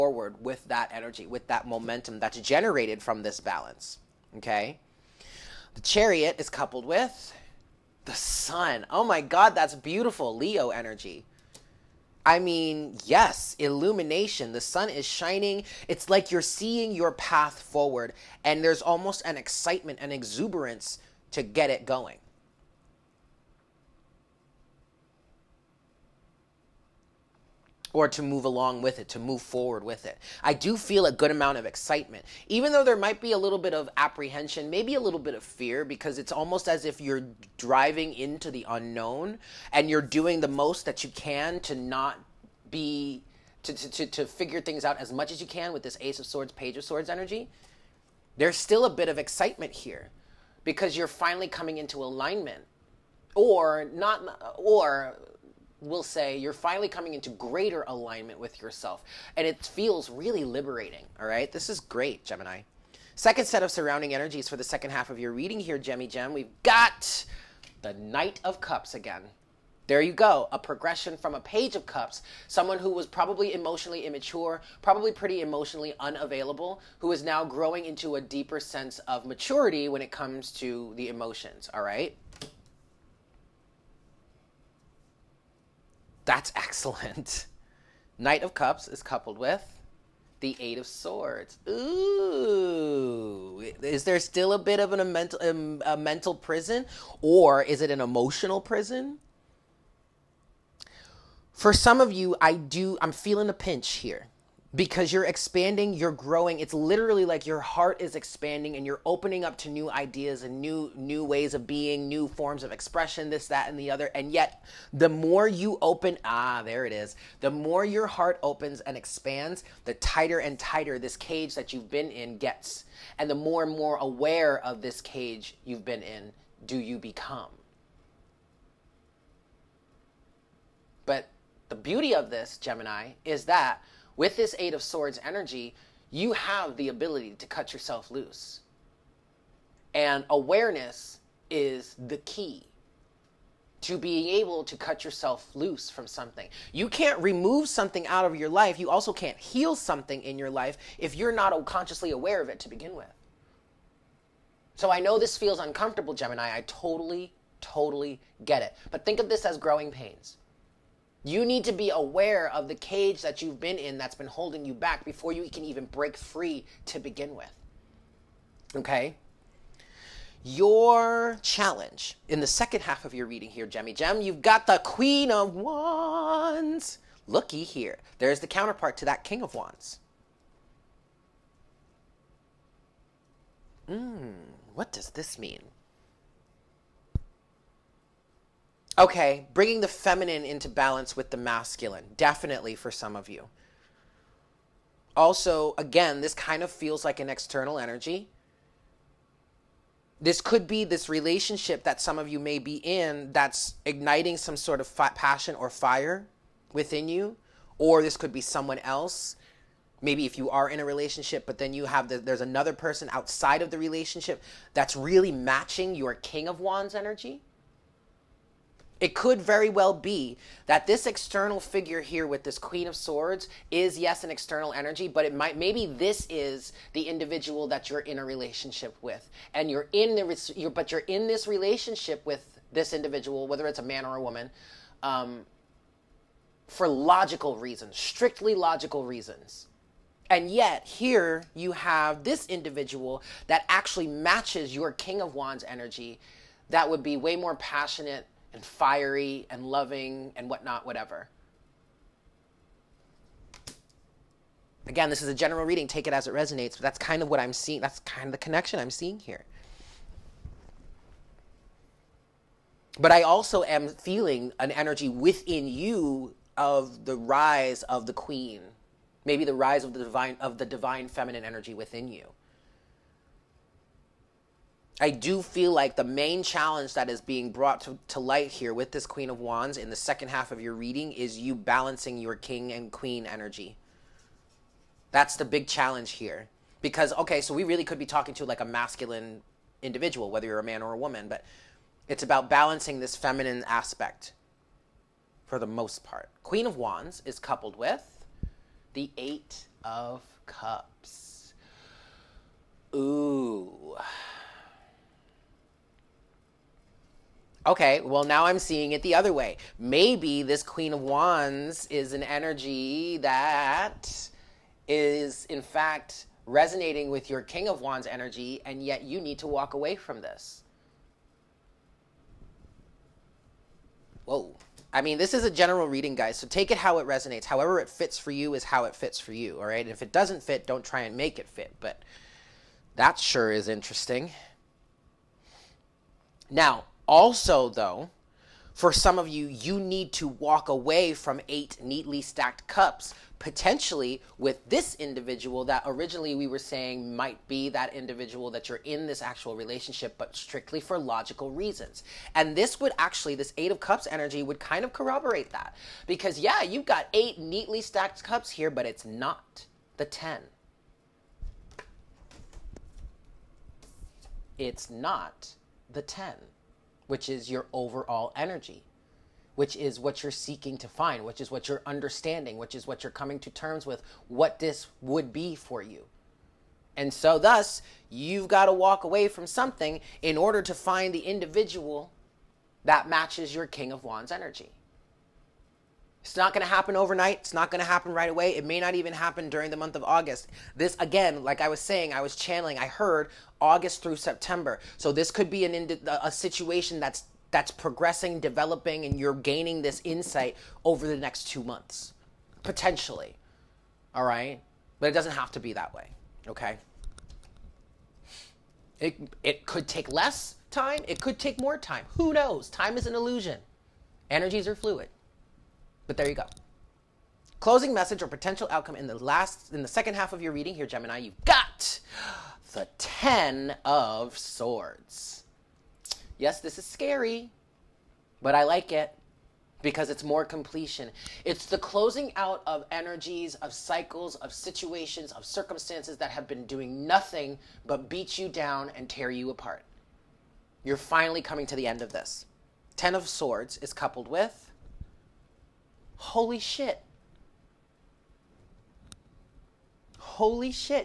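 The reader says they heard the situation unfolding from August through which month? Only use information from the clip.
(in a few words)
September.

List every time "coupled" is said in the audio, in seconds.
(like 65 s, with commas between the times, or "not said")
6 s, 89 s, 297 s, 443 s.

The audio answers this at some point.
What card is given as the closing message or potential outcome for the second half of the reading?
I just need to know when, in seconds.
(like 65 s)
422 s.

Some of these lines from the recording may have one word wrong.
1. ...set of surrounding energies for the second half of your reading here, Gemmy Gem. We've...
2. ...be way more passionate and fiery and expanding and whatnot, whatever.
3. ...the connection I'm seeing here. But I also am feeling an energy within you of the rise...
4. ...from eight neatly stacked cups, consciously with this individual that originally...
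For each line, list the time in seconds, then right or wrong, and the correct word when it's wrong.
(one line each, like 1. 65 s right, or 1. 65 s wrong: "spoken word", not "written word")
1. 63 s right
2. 247 s wrong: "loving", not "expanding"
3. 258 s right
4. 341 s wrong: "potentially", not "consciously".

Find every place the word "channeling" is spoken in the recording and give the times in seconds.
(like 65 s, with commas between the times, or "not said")
392 s.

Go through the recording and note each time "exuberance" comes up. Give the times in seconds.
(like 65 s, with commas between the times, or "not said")
20 s.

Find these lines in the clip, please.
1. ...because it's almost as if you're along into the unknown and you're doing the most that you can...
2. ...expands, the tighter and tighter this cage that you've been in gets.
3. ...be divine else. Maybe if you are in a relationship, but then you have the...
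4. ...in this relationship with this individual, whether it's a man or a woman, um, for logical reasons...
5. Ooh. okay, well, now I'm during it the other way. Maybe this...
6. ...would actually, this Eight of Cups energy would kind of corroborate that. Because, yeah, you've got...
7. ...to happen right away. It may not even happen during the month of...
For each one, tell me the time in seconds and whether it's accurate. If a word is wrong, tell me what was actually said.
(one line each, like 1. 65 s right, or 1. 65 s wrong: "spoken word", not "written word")
1. 35 s wrong: "driving", not "along"
2. 118 s right
3. 208 s wrong: "someone", not "divine"
4. 231 s right
5. 302 s wrong: "seeing", not "during"
6. 352 s right
7. 387 s right.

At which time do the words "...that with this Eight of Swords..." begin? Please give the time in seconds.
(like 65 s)
133 s.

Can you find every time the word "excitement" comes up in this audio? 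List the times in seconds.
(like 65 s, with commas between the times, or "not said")
19 s, 31 s, 49 s.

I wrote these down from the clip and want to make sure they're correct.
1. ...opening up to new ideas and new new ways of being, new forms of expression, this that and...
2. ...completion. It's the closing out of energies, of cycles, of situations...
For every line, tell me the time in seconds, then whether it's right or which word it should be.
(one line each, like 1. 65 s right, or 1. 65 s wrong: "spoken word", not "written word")
1. 109 s right
2. 430 s right.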